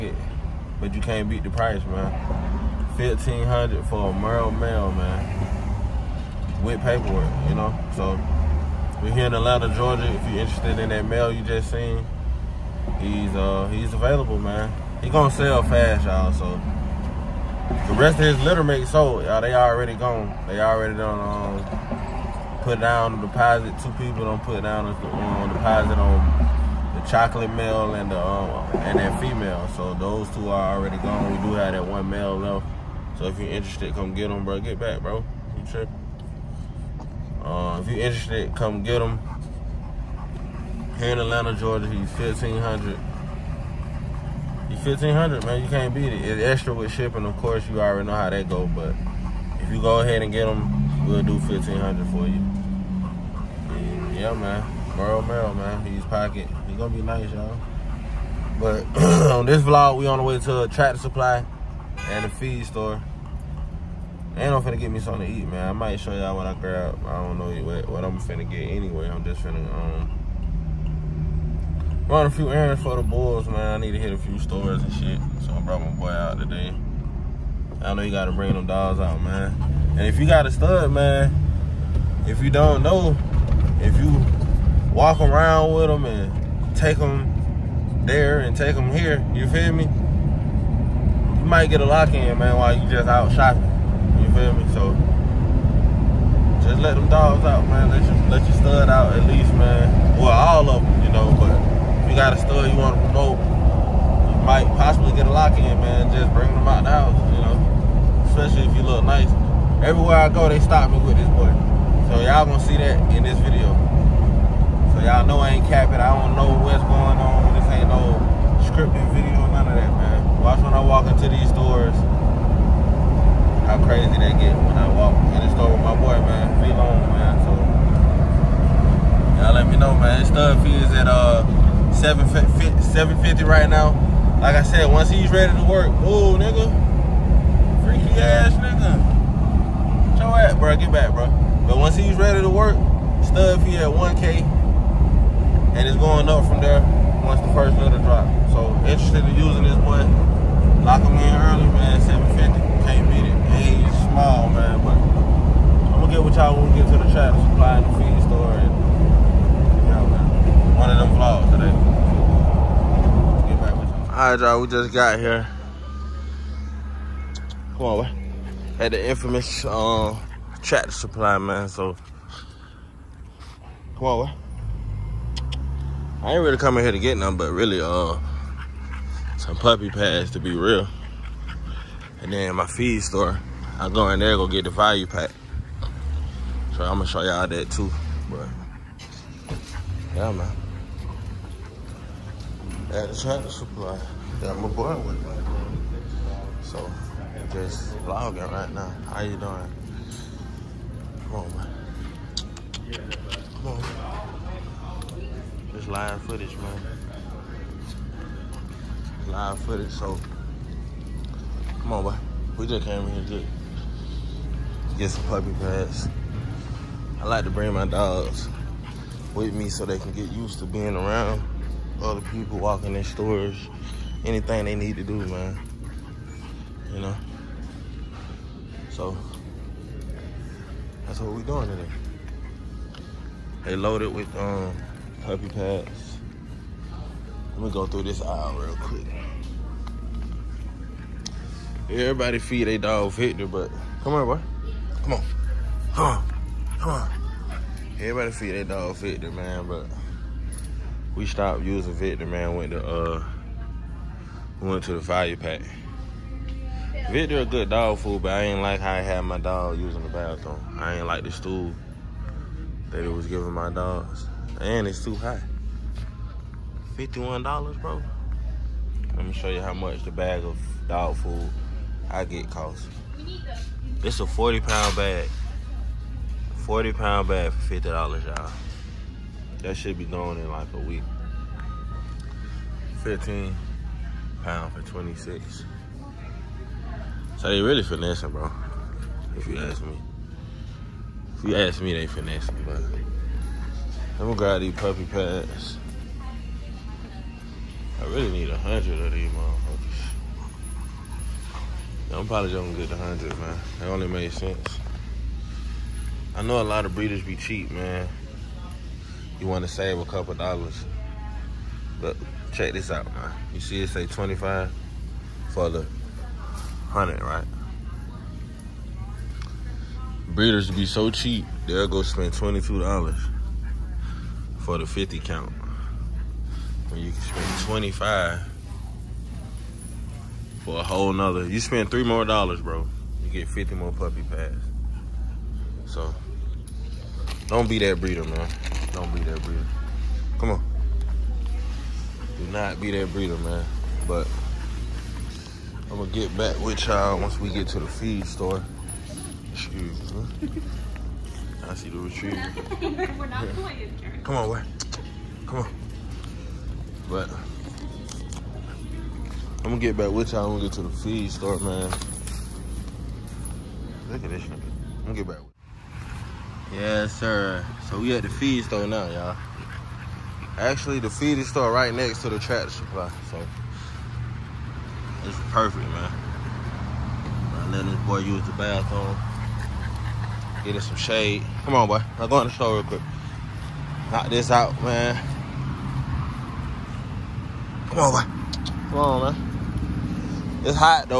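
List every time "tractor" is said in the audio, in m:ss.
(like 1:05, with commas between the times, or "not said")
1:00, 2:50, 3:13, 6:12.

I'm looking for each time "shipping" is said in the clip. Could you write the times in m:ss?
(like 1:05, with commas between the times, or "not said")
0:46.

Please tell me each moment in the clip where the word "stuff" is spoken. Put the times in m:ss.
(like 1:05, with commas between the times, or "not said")
2:10, 2:23.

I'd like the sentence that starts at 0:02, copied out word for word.
1500 for a Merle Male, man.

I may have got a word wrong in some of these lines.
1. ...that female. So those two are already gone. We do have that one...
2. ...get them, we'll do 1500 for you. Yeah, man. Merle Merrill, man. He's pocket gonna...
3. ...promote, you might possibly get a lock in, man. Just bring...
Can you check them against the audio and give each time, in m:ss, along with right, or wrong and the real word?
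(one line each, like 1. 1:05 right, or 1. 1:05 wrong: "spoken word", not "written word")
1. 0:28 right
2. 0:50 right
3. 1:43 right.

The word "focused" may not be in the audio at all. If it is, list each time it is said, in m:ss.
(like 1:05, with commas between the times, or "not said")
not said.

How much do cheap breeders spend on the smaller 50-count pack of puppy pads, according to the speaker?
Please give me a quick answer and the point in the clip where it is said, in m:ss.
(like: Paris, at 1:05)
$22, at 5:22.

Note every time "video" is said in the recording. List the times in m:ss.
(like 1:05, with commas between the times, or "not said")
1:53, 1:59.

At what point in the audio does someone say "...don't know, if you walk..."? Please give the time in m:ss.
1:22.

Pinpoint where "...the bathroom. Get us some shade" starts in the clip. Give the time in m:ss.
6:18.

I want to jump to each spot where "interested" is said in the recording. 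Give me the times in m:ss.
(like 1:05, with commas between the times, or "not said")
0:10, 0:33, 0:38, 2:28.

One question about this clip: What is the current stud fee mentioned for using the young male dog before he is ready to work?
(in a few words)
$750.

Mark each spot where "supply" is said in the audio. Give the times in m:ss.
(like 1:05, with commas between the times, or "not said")
1:00, 2:37, 2:50, 3:13, 6:12.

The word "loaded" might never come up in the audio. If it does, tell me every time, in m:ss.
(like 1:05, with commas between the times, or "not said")
3:53.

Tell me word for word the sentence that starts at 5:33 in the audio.
You get 50 more puppy pads.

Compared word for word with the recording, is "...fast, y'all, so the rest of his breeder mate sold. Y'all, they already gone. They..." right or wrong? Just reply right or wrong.
wrong.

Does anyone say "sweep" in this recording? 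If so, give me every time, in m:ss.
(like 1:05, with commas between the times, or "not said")
not said.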